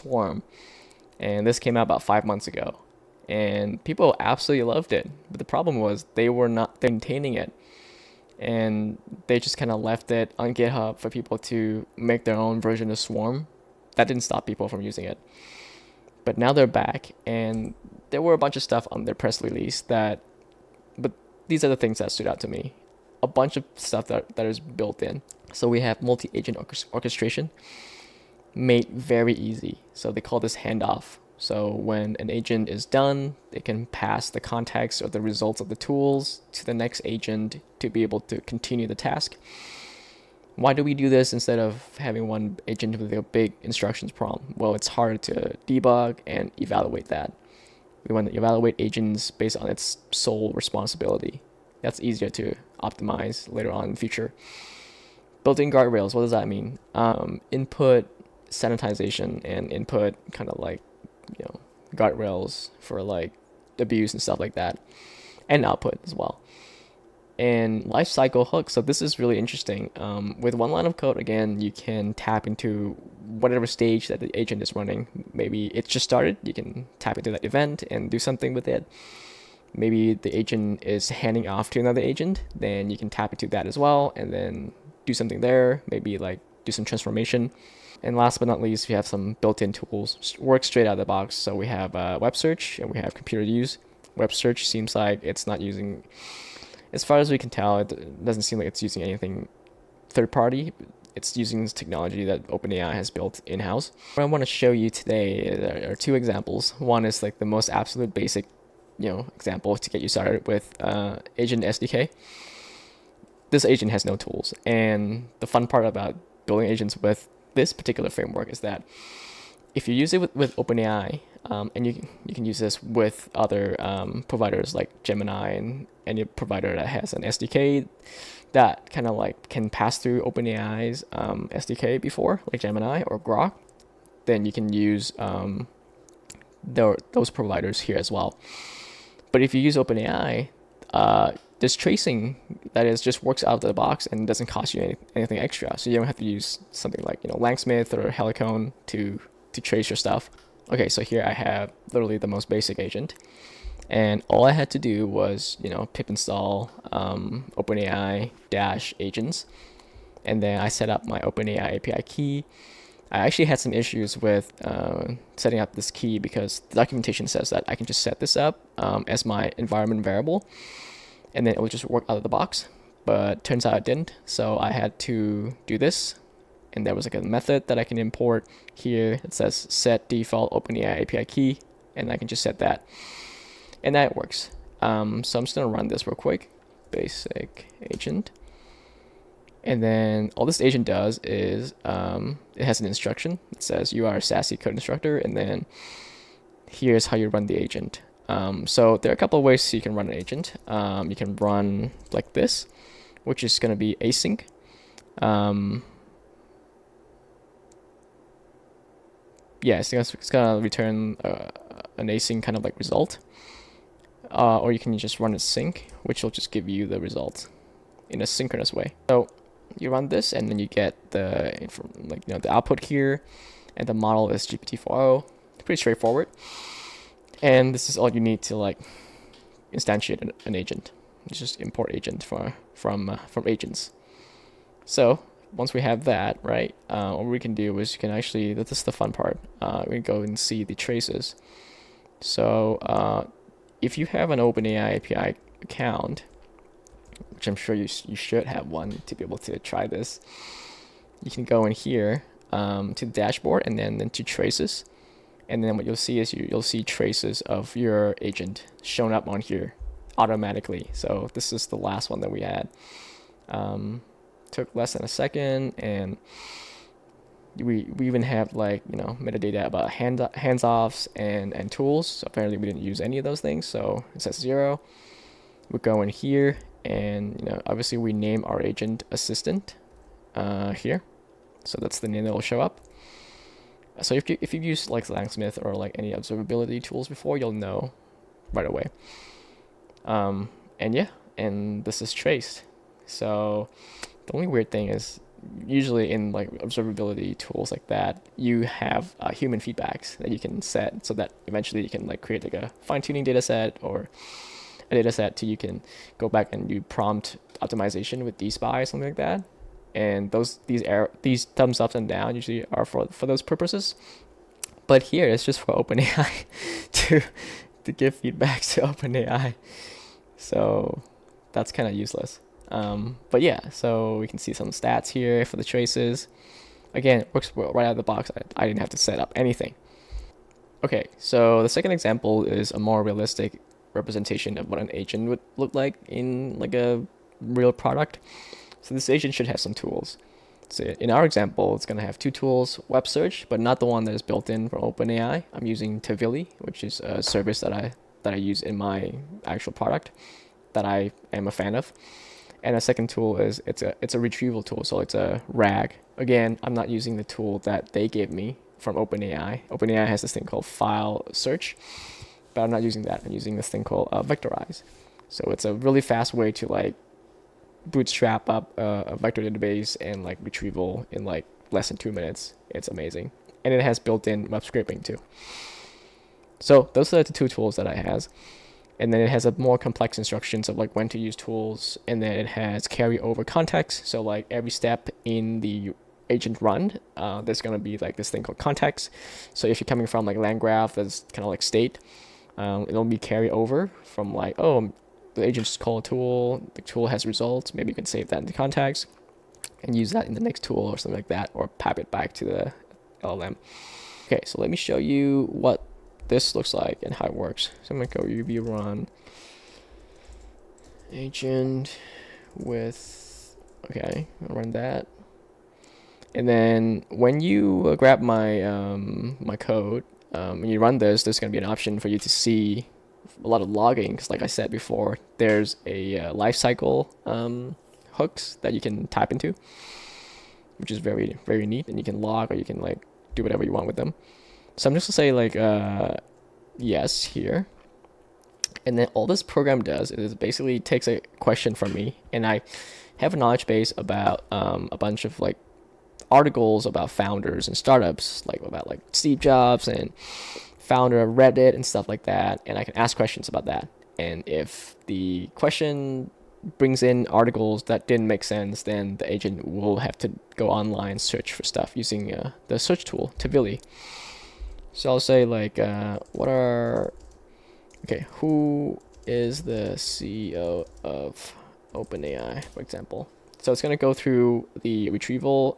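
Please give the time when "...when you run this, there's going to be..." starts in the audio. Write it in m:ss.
7:00.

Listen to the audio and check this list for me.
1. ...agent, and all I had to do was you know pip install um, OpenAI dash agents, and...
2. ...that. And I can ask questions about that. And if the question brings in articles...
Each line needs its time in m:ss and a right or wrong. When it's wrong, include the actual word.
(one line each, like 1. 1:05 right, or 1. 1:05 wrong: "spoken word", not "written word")
1. 2:32 right
2. 7:32 right.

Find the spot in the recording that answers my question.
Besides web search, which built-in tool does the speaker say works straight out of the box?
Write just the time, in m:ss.
1:33.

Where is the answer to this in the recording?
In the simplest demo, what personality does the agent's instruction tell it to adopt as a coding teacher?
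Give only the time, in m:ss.
3:14.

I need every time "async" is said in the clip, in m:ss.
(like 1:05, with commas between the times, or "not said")
3:24, 3:32.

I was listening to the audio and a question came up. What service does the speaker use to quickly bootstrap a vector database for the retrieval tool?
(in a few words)
Vectorize.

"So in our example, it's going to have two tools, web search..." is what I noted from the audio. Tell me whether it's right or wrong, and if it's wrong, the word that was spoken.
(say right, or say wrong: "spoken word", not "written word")
right.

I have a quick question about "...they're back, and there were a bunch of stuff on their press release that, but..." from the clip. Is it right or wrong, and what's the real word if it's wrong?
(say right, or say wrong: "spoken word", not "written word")
right.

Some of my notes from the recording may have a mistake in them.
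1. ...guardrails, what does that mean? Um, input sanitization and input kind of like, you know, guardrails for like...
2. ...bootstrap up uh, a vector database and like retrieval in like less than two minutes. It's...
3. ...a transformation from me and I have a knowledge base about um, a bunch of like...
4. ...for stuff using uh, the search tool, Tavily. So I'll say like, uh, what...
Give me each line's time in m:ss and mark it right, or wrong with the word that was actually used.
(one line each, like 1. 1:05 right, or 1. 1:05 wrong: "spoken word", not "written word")
1. 0:55 right
2. 6:07 right
3. 7:21 wrong: "question", not "transformation"
4. 7:41 right.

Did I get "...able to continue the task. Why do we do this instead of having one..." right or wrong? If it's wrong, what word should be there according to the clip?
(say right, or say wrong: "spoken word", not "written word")
right.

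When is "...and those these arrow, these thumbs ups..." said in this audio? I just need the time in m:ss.
5:09.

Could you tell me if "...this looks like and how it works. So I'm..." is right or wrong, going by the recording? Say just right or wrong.
right.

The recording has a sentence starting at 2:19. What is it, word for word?
But if you use OpenAI, uh, tracing that is just works out of the box and doesn't cost you any, anything extra.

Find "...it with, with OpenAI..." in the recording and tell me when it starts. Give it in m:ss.
2:00.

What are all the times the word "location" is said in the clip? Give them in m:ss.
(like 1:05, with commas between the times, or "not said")
not said.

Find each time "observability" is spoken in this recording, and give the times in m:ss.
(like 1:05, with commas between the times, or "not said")
4:46, 4:56.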